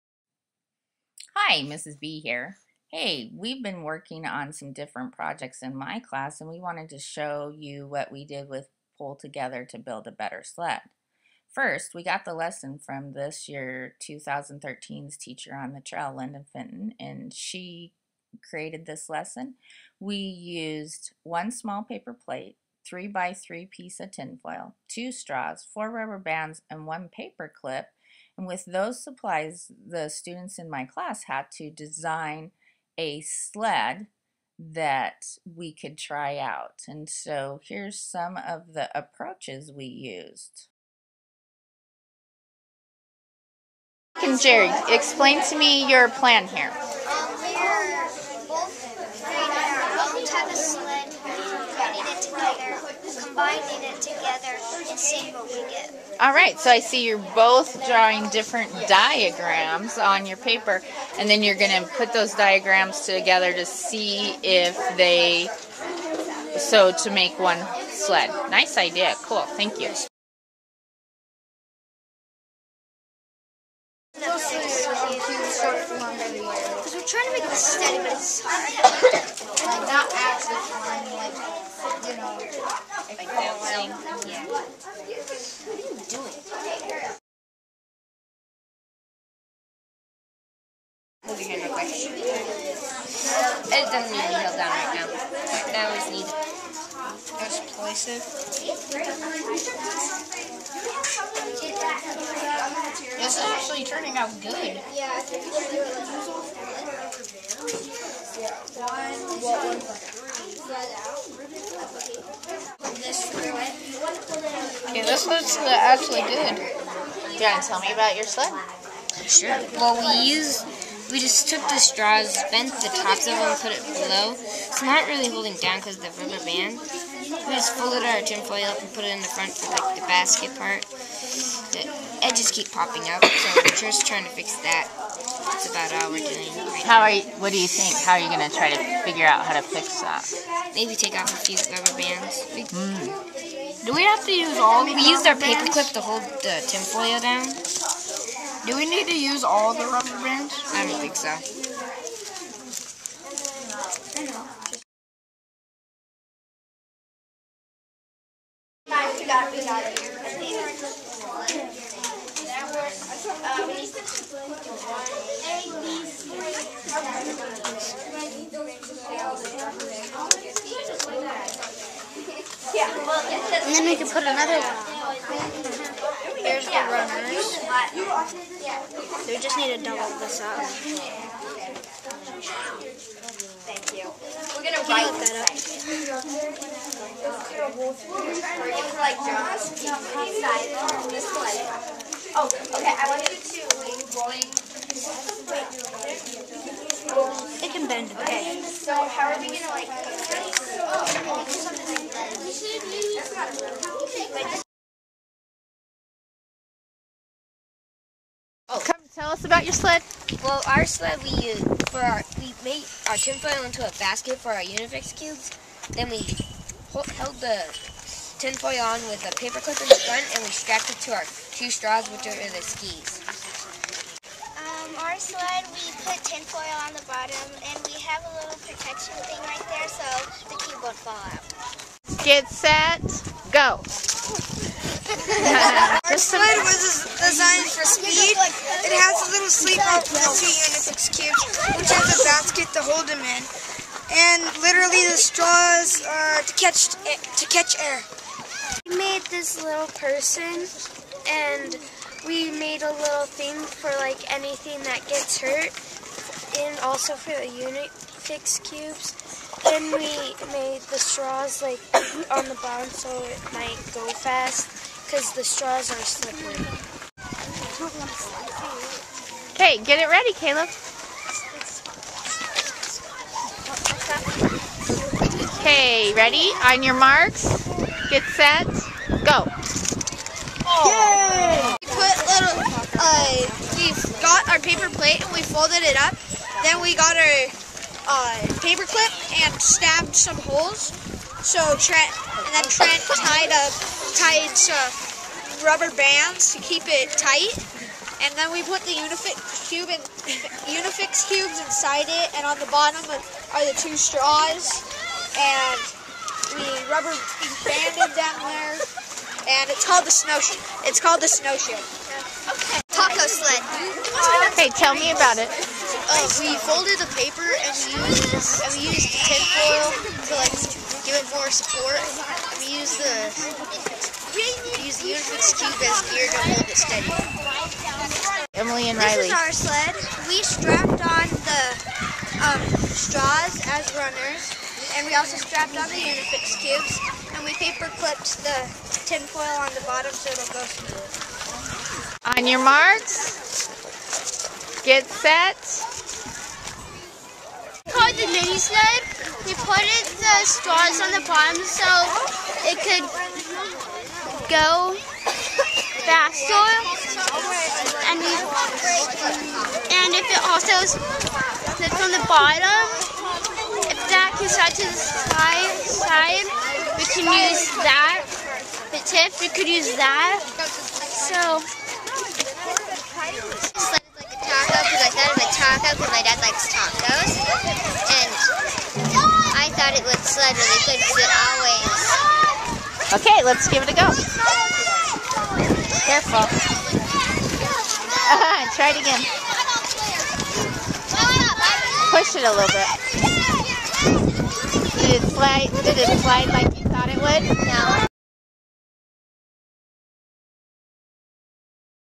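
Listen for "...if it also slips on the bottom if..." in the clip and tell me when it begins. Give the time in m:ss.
6:00.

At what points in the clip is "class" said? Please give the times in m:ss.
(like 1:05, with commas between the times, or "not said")
0:05, 0:30.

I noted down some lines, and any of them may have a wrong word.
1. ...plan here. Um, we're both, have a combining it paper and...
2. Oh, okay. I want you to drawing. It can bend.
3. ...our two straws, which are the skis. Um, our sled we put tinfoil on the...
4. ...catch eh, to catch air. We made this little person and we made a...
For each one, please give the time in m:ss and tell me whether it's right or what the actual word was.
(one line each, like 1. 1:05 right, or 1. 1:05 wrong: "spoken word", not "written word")
1. 0:46 wrong: "together", not "paper"
2. 3:12 wrong: "rolling", not "drawing"
3. 3:41 right
4. 4:06 right.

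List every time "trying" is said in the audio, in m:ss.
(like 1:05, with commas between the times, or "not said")
1:17, 2:14.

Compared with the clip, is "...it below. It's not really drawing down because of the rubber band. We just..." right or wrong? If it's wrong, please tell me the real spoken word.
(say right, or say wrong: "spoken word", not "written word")
wrong: "holding", not "drawing".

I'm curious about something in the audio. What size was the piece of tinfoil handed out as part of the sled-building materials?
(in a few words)
3 by 3.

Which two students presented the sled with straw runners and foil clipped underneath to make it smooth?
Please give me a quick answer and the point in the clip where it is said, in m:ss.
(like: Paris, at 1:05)
Emily and Riley, at 5:28.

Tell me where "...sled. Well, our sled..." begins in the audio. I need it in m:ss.
3:29.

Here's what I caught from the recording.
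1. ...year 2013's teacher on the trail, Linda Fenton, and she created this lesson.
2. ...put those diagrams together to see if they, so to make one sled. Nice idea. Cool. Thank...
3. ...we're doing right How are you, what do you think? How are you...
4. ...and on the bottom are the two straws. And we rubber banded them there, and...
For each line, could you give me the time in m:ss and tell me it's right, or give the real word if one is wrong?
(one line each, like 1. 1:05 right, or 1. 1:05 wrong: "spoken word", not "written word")
1. 0:13 right
2. 1:01 right
3. 2:16 right
4. 5:02 right.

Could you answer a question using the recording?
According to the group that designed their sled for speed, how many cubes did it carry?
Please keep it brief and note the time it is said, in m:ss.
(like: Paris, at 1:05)
6, at 4:01.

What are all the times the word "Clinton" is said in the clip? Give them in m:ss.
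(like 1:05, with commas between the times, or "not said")
not said.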